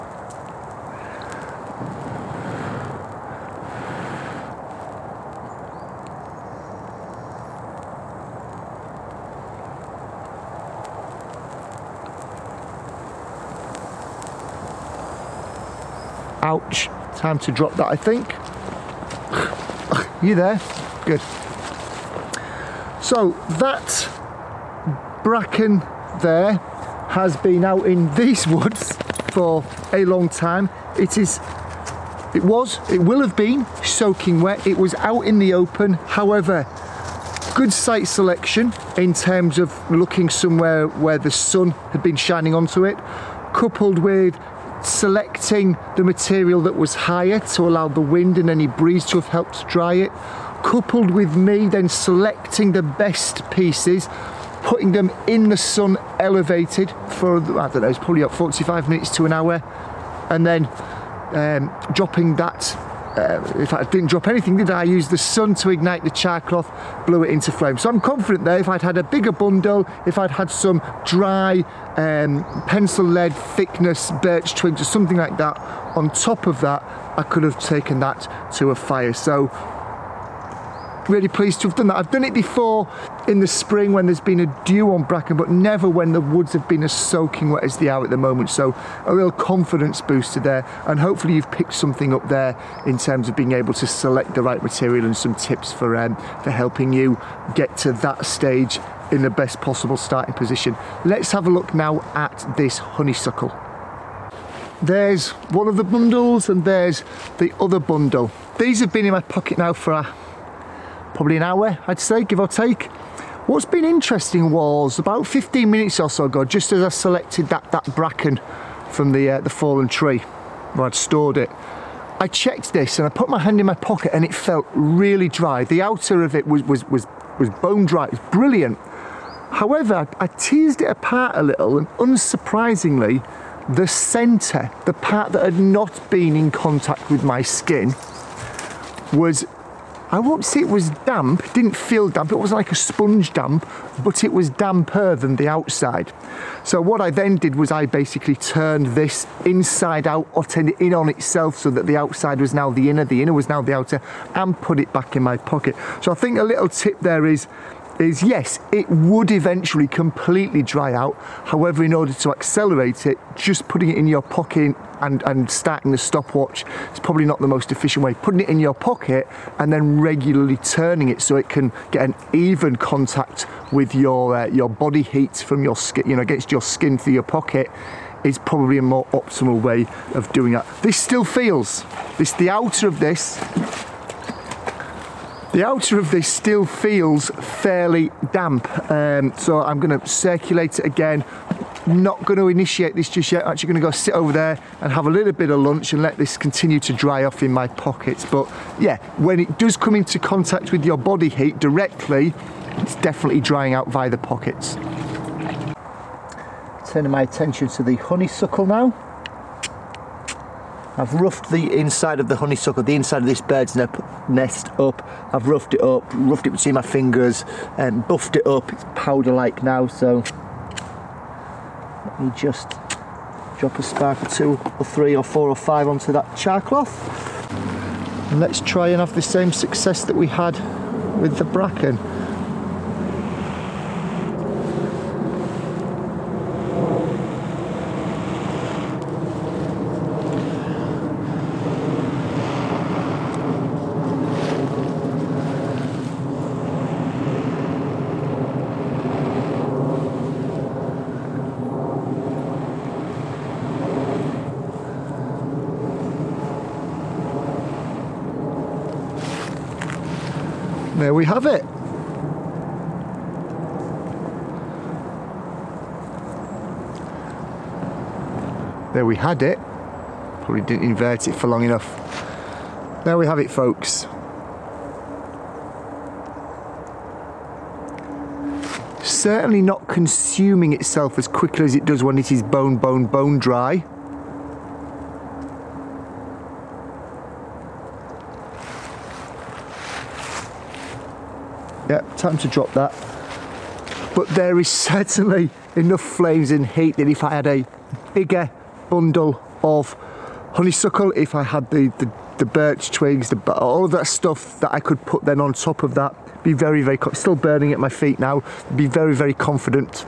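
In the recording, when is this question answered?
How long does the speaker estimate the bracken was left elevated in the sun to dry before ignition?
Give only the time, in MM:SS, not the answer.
00:58.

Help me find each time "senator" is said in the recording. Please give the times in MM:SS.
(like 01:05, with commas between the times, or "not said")
not said.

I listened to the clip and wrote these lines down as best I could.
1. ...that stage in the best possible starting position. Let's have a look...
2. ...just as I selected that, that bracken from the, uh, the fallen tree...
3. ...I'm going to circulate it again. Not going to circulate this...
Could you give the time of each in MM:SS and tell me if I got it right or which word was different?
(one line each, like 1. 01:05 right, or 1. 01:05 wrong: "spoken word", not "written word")
1. 01:37 right
2. 01:56 right
3. 03:09 wrong: "initiate", not "circulate".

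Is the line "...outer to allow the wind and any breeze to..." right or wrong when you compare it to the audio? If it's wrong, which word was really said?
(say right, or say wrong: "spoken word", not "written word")
wrong: "higher", not "outer".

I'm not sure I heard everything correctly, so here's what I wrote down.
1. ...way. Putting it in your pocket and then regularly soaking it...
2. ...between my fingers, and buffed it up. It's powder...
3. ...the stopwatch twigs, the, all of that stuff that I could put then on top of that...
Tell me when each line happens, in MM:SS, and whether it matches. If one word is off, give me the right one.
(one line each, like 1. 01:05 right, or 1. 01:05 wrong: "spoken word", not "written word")
1. 02:48 wrong: "turning", not "soaking"
2. 03:36 right
3. 05:02 wrong: "birch", not "stopwatch".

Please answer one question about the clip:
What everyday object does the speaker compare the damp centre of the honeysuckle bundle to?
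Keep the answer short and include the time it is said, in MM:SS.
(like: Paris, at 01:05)
a sponge, at 02:22.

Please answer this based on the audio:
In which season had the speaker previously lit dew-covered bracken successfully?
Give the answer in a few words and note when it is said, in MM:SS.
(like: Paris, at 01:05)
spring, at 01:23.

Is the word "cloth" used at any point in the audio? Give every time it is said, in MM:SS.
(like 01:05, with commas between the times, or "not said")
01:06, 03:46.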